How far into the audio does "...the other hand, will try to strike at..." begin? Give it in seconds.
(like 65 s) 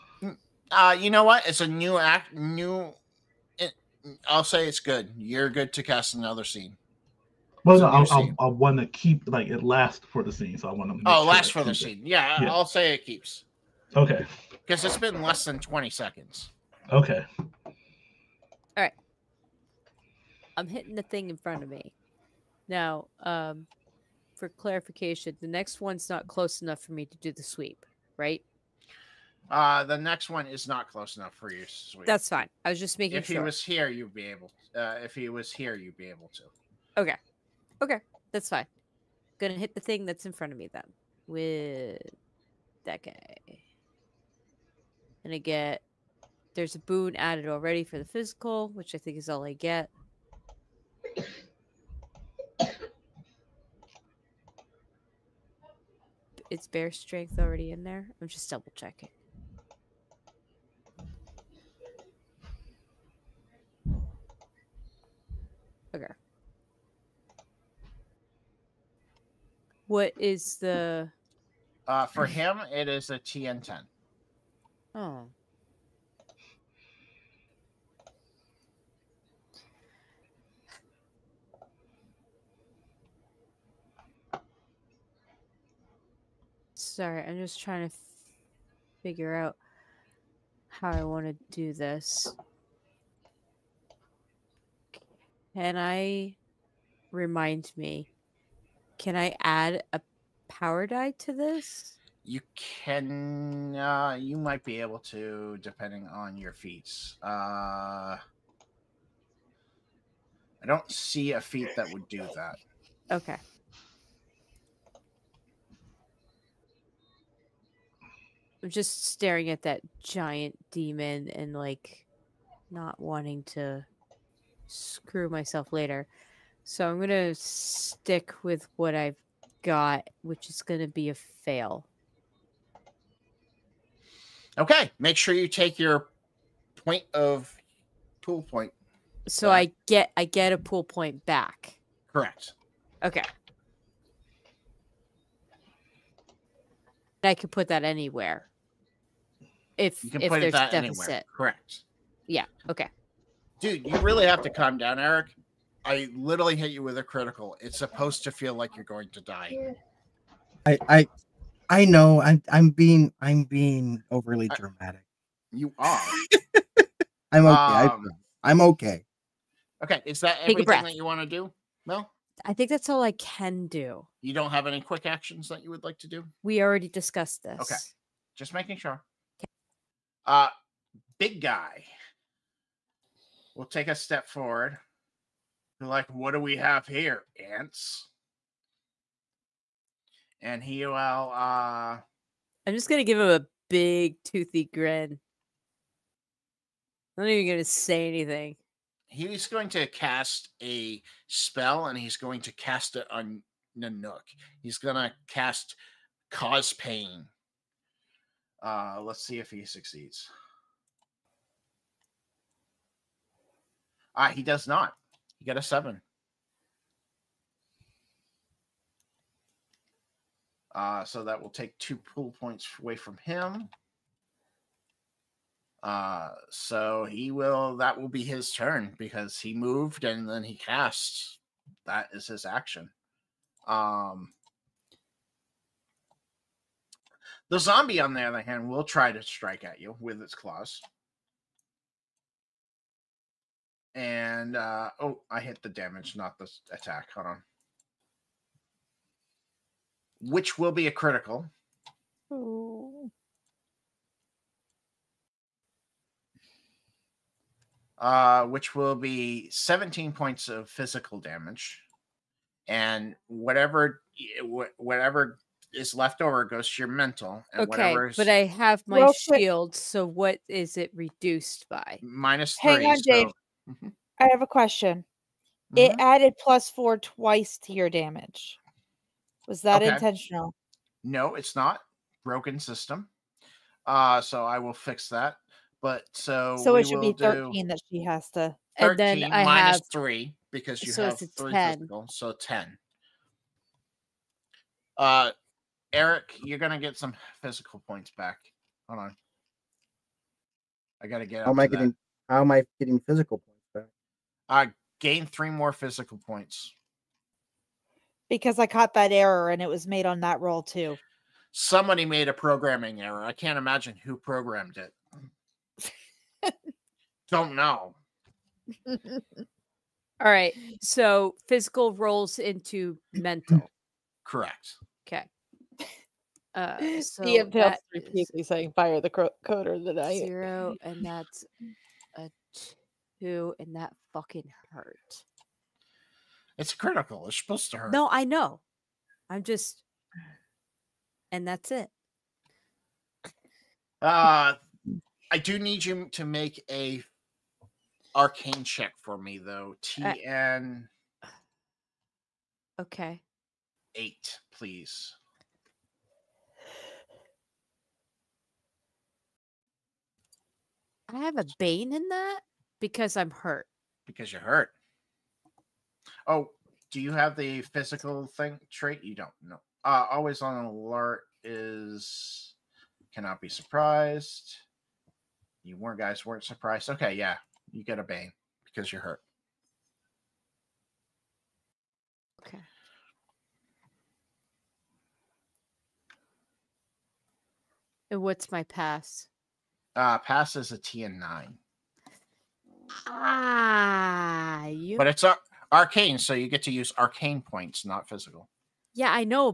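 238 s.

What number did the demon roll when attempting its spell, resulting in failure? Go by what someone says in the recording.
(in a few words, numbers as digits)
7.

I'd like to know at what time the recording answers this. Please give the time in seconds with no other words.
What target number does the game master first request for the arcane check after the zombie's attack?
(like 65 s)
353 s.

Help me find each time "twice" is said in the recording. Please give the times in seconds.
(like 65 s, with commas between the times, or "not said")
276 s.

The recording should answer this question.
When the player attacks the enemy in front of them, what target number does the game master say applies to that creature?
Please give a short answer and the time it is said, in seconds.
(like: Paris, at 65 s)
TN10, at 73 s.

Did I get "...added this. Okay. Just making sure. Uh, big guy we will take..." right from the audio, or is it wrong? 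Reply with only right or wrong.
wrong.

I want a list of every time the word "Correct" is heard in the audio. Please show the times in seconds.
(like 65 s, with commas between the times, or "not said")
142 s, 151 s, 324 s.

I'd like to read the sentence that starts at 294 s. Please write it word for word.
Uh, Eric, you're gonna get some physical points back.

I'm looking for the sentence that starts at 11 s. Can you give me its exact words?
Oh, sure lasts for the scene.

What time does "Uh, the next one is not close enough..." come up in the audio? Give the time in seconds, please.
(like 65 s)
29 s.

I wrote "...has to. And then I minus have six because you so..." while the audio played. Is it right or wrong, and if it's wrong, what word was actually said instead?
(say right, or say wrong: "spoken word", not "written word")
wrong: "three", not "six".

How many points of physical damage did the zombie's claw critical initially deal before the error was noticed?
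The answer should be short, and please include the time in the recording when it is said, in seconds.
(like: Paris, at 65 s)
17, at 259 s.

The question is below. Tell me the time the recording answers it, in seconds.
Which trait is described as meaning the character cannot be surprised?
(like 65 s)
370 s.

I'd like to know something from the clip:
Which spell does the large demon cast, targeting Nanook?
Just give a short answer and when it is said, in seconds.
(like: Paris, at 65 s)
Cause Pain, at 206 s.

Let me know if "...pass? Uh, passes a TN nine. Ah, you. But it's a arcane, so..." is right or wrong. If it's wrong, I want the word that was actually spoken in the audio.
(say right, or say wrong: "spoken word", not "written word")
right.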